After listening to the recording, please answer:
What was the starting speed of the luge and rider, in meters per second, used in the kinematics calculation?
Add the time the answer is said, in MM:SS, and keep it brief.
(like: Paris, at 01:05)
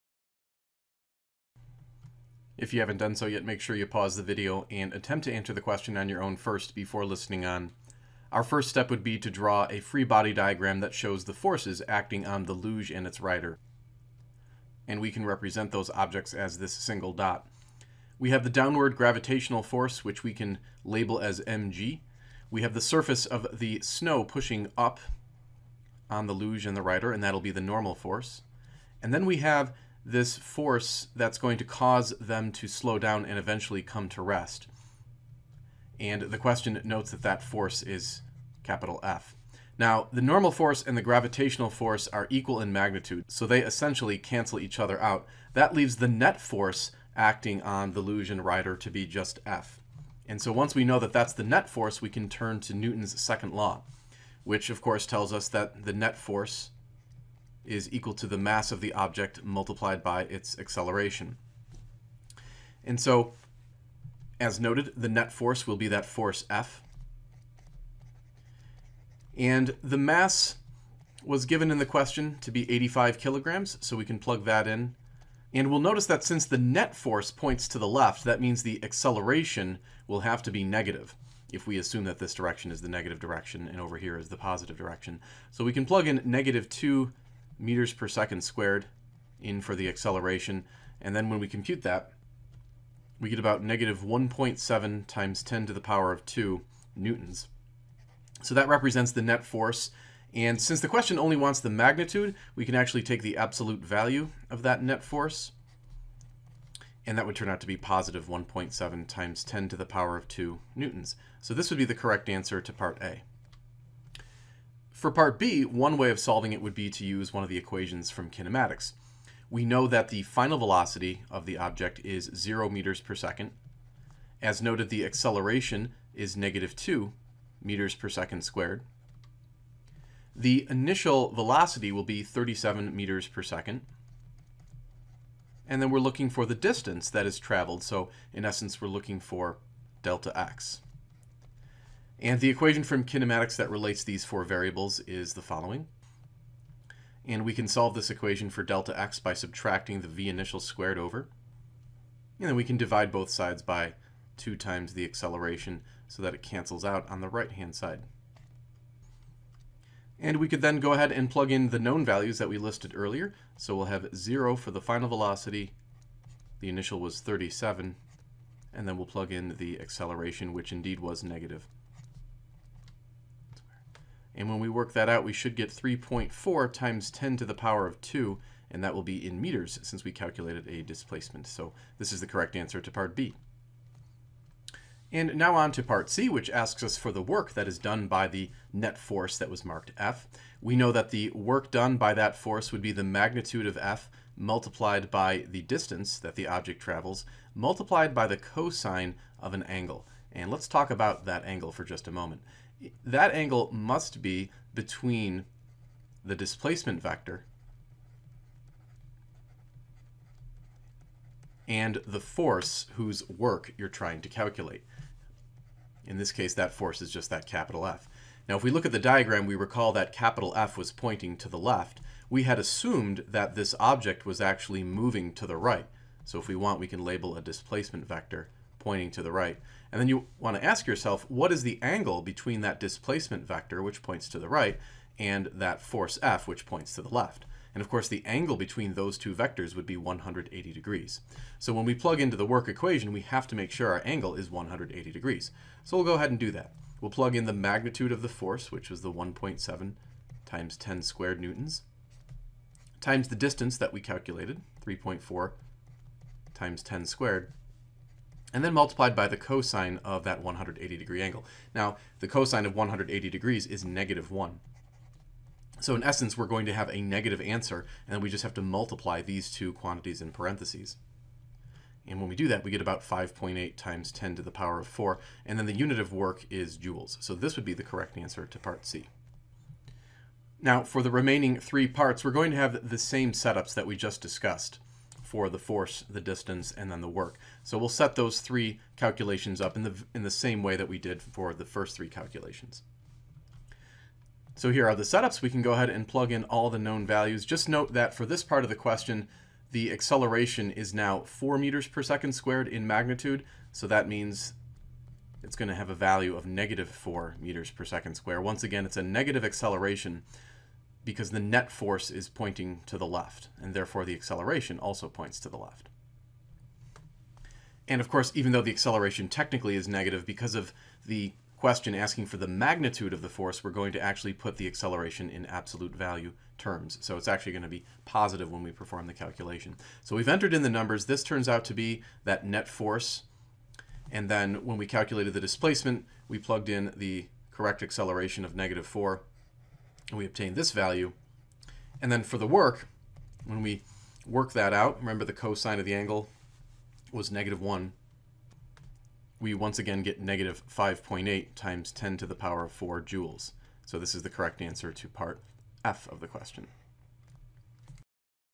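37 meters per second, at 02:12.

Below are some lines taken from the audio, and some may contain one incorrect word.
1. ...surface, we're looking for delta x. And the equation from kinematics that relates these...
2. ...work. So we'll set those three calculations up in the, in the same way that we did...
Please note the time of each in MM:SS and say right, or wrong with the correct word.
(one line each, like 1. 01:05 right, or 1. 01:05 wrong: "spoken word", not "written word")
1. 02:18 wrong: "essence", not "surface"
2. 04:47 right.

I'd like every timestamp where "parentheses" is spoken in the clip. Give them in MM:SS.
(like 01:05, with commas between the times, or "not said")
04:30.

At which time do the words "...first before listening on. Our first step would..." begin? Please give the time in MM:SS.
00:06.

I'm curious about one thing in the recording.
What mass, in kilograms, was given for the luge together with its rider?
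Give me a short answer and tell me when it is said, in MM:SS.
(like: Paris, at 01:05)
85 kilograms, at 01:12.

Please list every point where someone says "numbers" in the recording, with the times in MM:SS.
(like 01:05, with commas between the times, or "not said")
05:30.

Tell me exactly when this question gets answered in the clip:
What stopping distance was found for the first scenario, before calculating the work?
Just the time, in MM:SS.
02:55.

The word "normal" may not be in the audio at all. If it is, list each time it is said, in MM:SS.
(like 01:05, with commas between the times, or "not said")
00:27, 00:40.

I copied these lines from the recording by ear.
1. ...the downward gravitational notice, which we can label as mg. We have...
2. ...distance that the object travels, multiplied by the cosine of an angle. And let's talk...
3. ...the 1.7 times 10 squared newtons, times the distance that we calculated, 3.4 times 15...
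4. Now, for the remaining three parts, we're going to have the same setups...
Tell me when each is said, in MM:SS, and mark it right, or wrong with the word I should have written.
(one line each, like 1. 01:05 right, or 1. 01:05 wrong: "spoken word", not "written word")
1. 00:18 wrong: "force", not "notice"
2. 03:15 right
3. 04:09 wrong: "10", not "15"
4. 04:40 right.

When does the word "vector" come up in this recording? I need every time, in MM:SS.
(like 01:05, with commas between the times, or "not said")
03:27, 03:48, 03:53, 03:59.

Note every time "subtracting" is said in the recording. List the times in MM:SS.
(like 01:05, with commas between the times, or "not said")
02:29.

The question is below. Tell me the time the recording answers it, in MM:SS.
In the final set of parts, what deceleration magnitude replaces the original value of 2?
05:01.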